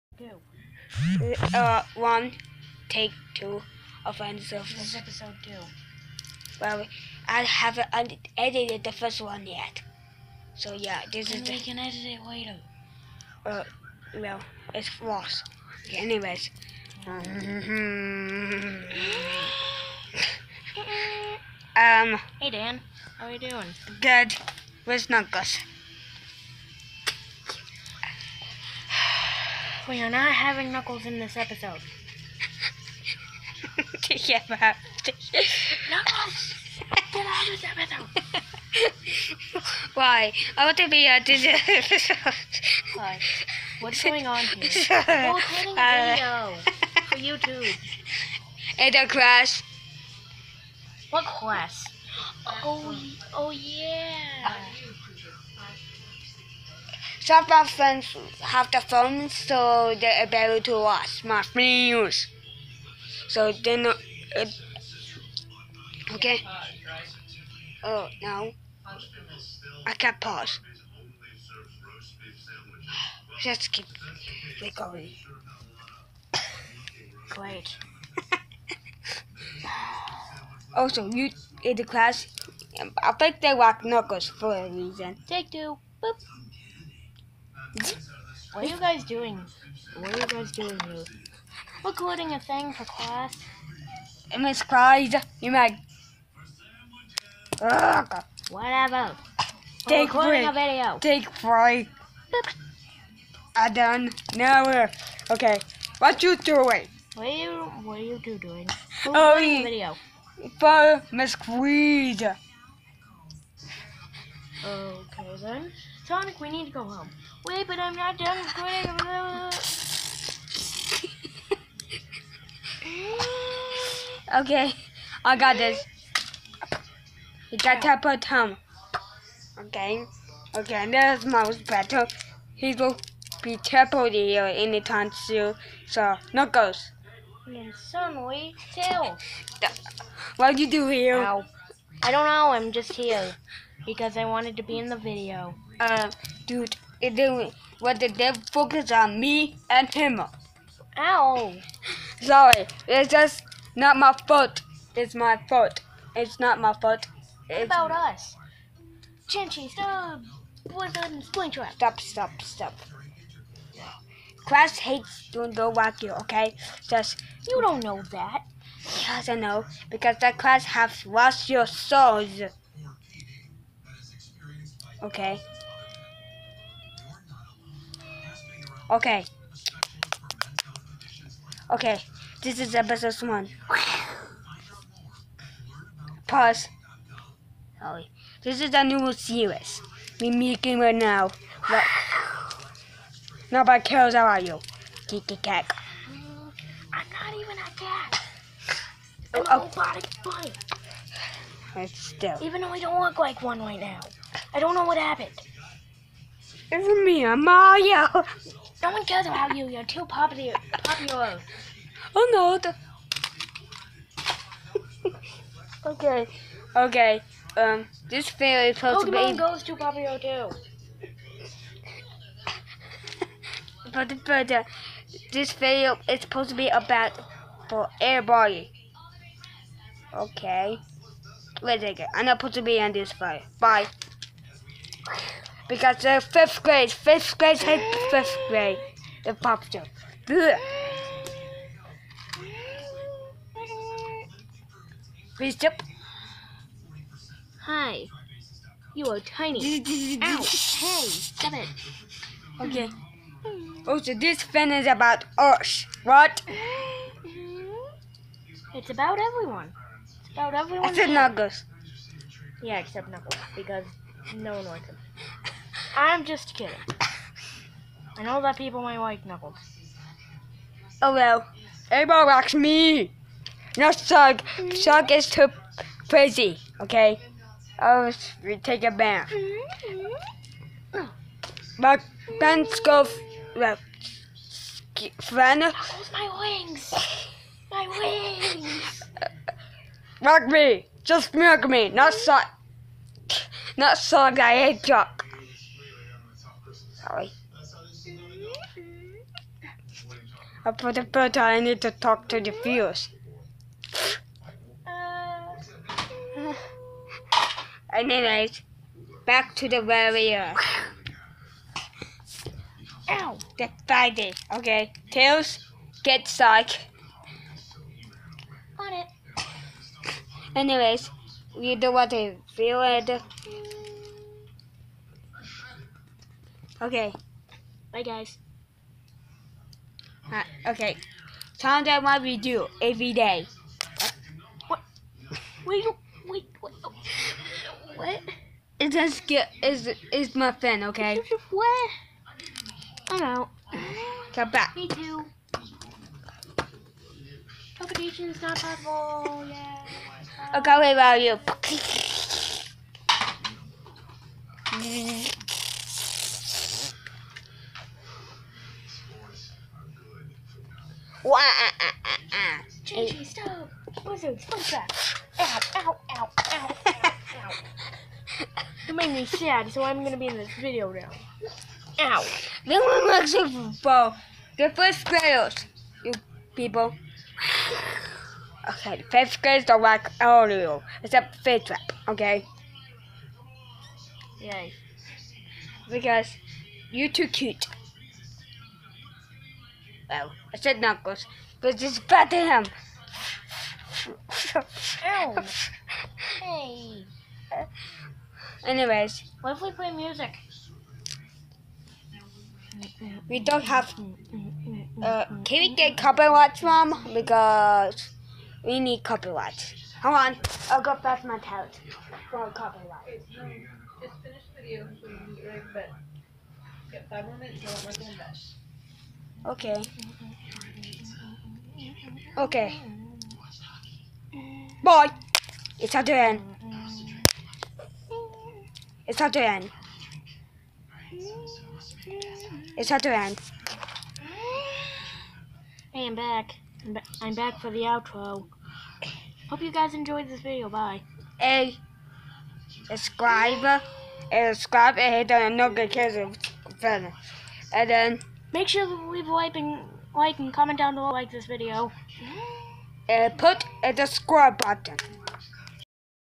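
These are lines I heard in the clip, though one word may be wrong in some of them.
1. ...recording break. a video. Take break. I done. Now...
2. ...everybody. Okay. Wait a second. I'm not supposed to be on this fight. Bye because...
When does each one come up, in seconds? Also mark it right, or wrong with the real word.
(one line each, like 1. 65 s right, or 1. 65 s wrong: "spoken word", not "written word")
1. 100 s right
2. 227 s right.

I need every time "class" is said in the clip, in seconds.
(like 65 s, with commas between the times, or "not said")
81 s, 92 s, 170 s.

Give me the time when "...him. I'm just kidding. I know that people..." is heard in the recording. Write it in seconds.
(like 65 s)
264 s.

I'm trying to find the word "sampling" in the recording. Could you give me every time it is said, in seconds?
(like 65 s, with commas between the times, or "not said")
not said.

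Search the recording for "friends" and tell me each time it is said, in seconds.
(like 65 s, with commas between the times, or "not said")
57 s, 285 s.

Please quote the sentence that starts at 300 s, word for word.
Uh, the first I need to talk to the viewers.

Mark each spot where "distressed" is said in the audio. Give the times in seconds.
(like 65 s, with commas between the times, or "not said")
not said.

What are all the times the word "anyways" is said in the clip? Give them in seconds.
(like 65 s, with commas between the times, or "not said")
15 s, 307 s, 320 s, 398 s.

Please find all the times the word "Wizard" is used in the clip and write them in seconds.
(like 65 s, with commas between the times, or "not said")
160 s, 364 s.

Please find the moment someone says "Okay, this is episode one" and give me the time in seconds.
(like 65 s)
181 s.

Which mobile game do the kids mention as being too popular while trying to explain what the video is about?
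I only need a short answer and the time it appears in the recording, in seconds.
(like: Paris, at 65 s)
Pokemon Go, at 219 s.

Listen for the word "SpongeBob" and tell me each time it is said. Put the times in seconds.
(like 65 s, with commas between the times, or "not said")
364 s.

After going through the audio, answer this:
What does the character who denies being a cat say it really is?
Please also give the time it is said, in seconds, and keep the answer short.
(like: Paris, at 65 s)
robotic bunny, at 199 s.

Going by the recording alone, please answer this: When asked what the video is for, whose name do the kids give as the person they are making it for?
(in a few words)
Miss Creed.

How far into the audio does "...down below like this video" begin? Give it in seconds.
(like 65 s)
450 s.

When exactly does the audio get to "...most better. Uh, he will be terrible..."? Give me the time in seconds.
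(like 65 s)
131 s.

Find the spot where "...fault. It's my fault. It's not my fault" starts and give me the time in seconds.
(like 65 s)
154 s.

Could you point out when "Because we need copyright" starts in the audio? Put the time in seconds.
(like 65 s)
407 s.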